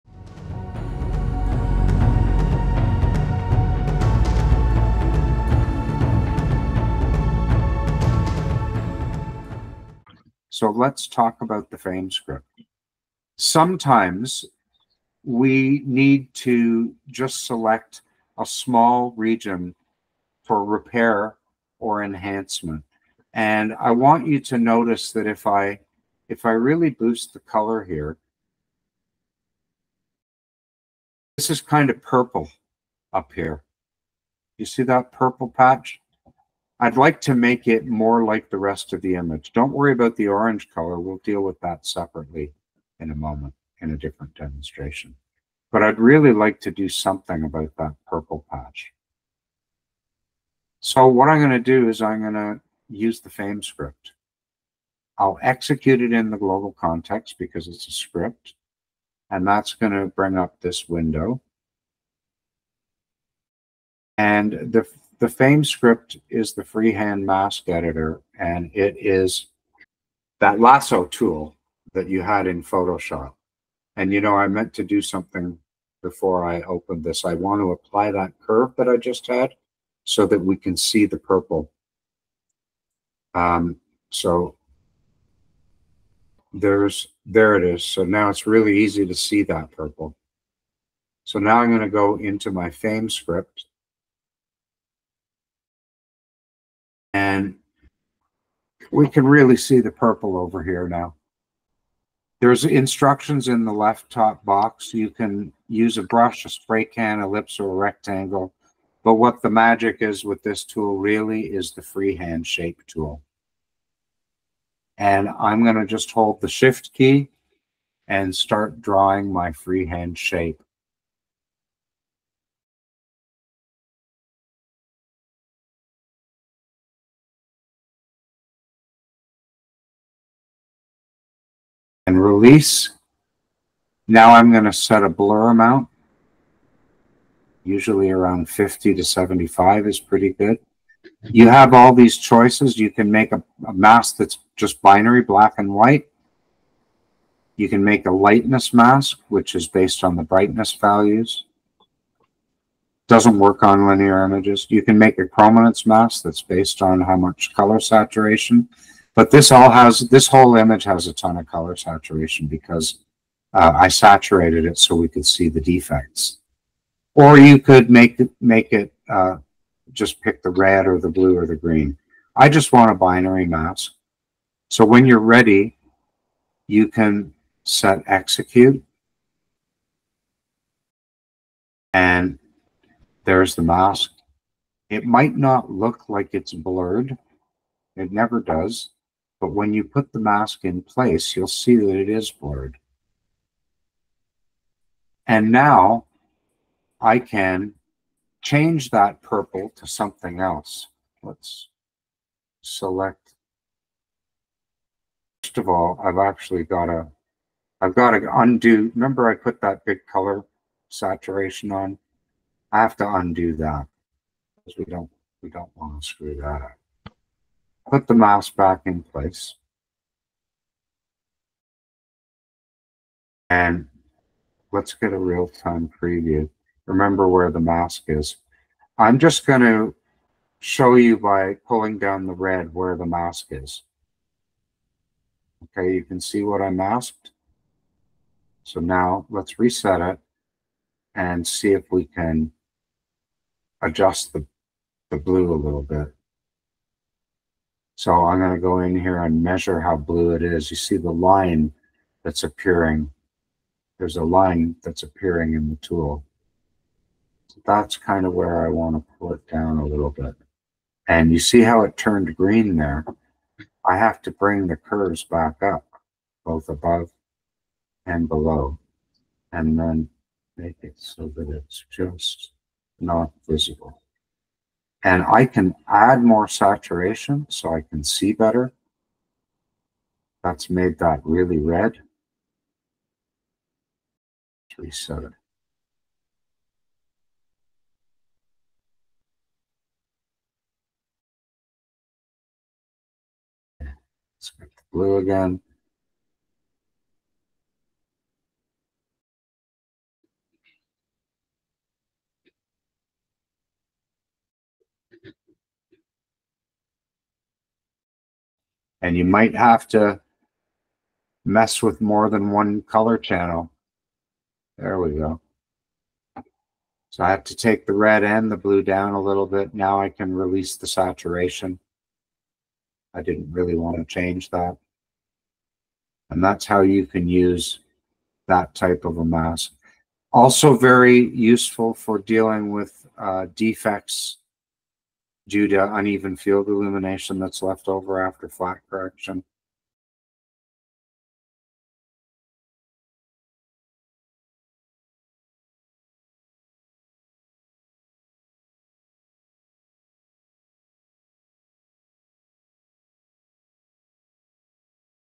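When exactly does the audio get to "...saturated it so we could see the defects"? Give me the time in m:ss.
2:43.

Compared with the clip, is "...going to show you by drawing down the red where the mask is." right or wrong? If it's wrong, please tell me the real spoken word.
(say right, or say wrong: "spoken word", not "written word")
wrong: "pulling", not "drawing".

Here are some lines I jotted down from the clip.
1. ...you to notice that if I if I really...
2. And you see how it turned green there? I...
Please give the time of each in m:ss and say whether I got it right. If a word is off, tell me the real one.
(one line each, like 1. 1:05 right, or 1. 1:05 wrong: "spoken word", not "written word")
1. 0:24 right
2. 4:21 right.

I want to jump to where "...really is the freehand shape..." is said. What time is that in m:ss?
1:50.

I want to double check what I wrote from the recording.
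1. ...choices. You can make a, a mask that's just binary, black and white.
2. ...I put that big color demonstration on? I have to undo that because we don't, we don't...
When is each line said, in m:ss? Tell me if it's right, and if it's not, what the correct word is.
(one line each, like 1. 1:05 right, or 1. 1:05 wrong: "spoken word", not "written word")
1. 2:22 right
2. 3:29 wrong: "saturation", not "demonstration".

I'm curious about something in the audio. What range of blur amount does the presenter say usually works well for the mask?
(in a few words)
50 to 75.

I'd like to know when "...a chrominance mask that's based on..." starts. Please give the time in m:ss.
2:35.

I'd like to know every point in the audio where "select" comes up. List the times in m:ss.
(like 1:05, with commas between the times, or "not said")
0:17, 3:22.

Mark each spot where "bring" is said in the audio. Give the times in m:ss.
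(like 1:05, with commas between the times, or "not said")
1:00, 4:24.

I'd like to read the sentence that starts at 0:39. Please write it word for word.
Don't worry about the orange color.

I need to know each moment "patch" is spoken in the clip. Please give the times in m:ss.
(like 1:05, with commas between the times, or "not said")
0:35, 0:48.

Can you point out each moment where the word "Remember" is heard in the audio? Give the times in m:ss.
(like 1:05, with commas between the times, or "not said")
3:28, 3:46.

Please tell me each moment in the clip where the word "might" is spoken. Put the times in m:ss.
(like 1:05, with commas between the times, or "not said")
3:05, 5:09.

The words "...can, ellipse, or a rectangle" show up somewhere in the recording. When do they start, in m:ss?
1:46.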